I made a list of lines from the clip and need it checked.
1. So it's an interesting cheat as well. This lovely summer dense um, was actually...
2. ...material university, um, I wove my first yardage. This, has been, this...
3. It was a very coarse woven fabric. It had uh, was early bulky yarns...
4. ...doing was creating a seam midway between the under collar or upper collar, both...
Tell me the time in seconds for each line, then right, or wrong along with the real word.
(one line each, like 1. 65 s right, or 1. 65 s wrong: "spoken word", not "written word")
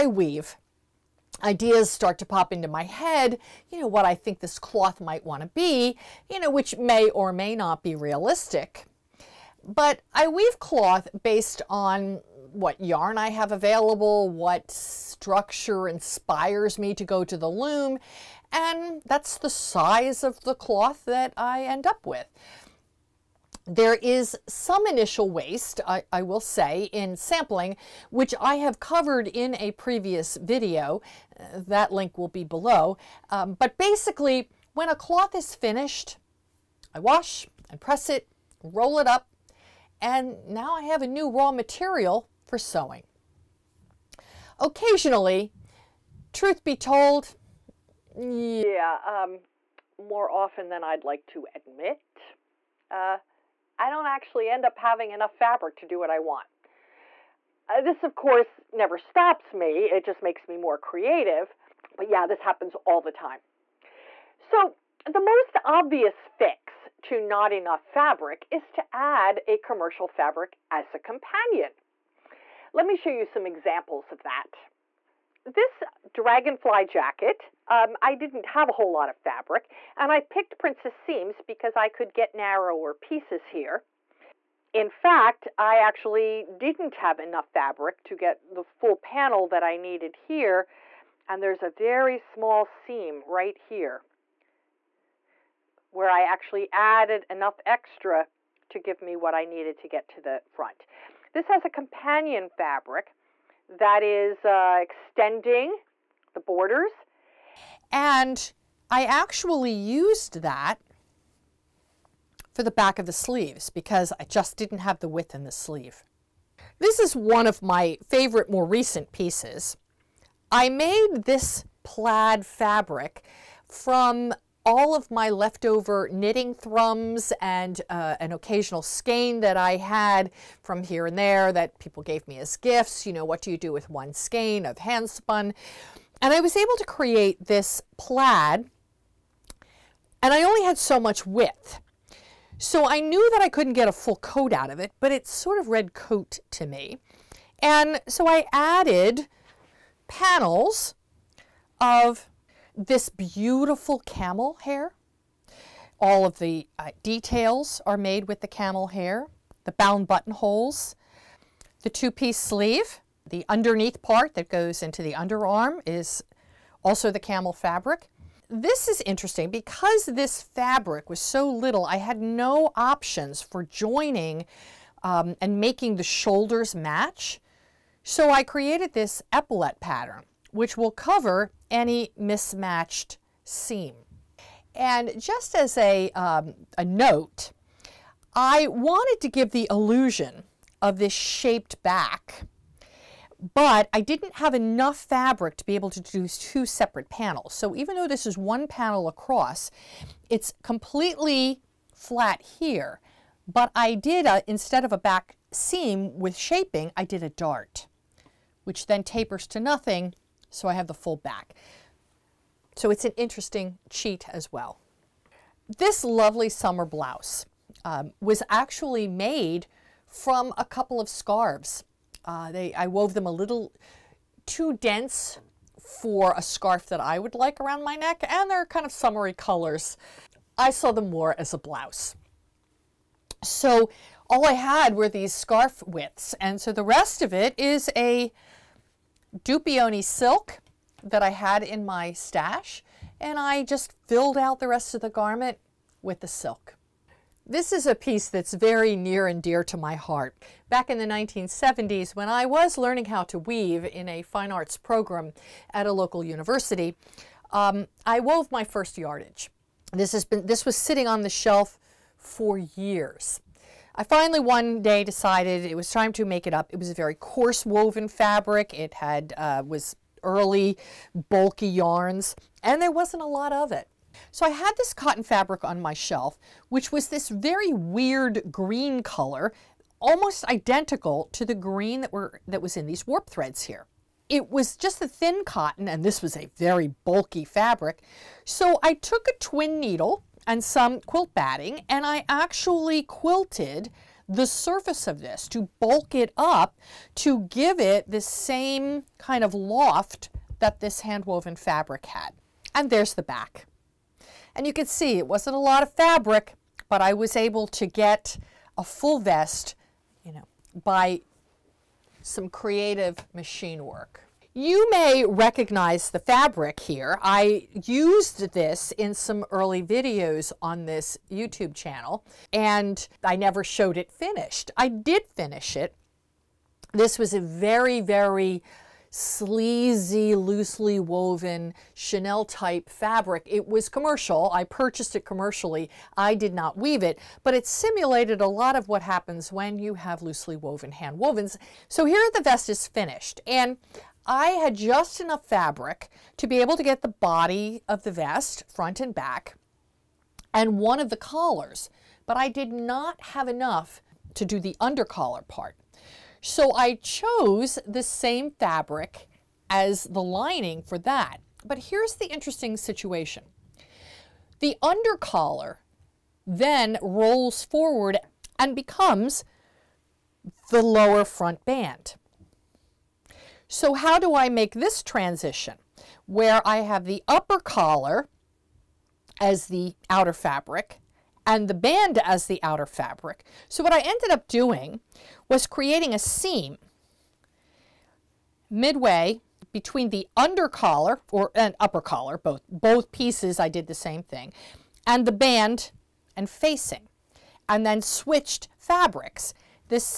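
1. 212 s wrong: "blouse", not "dense"
2. 255 s wrong: "local", not "material"
3. 266 s right
4. 384 s right.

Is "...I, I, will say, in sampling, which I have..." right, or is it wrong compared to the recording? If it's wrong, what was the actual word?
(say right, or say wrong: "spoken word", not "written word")
right.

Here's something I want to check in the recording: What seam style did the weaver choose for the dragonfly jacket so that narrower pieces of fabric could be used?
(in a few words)
Princess seams.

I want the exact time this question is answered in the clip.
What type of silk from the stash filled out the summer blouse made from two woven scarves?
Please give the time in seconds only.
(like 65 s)
239 s.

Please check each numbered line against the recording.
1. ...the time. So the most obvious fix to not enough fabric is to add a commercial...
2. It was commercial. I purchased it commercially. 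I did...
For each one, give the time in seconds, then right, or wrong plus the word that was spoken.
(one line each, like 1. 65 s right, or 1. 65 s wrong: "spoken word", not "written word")
1. 62 s right
2. 333 s right.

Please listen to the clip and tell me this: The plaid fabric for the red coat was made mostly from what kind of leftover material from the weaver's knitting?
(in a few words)
Knitting thrums.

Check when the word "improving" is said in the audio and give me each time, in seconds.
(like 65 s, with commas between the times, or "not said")
not said.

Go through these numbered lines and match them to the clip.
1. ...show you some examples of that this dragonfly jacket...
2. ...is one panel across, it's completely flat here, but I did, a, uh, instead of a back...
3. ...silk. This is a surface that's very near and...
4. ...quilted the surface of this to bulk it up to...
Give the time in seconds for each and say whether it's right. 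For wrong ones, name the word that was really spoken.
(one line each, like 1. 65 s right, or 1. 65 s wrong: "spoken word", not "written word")
1. 72 s right
2. 198 s right
3. 246 s wrong: "piece", not "surface"
4. 293 s right.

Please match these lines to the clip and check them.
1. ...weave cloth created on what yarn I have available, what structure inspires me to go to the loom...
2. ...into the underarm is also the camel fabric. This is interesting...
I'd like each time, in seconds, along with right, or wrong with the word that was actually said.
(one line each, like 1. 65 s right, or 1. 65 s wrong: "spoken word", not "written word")
1. 10 s wrong: "based", not "created"
2. 164 s right.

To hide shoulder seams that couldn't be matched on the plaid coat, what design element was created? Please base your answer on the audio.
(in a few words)
Epaulette.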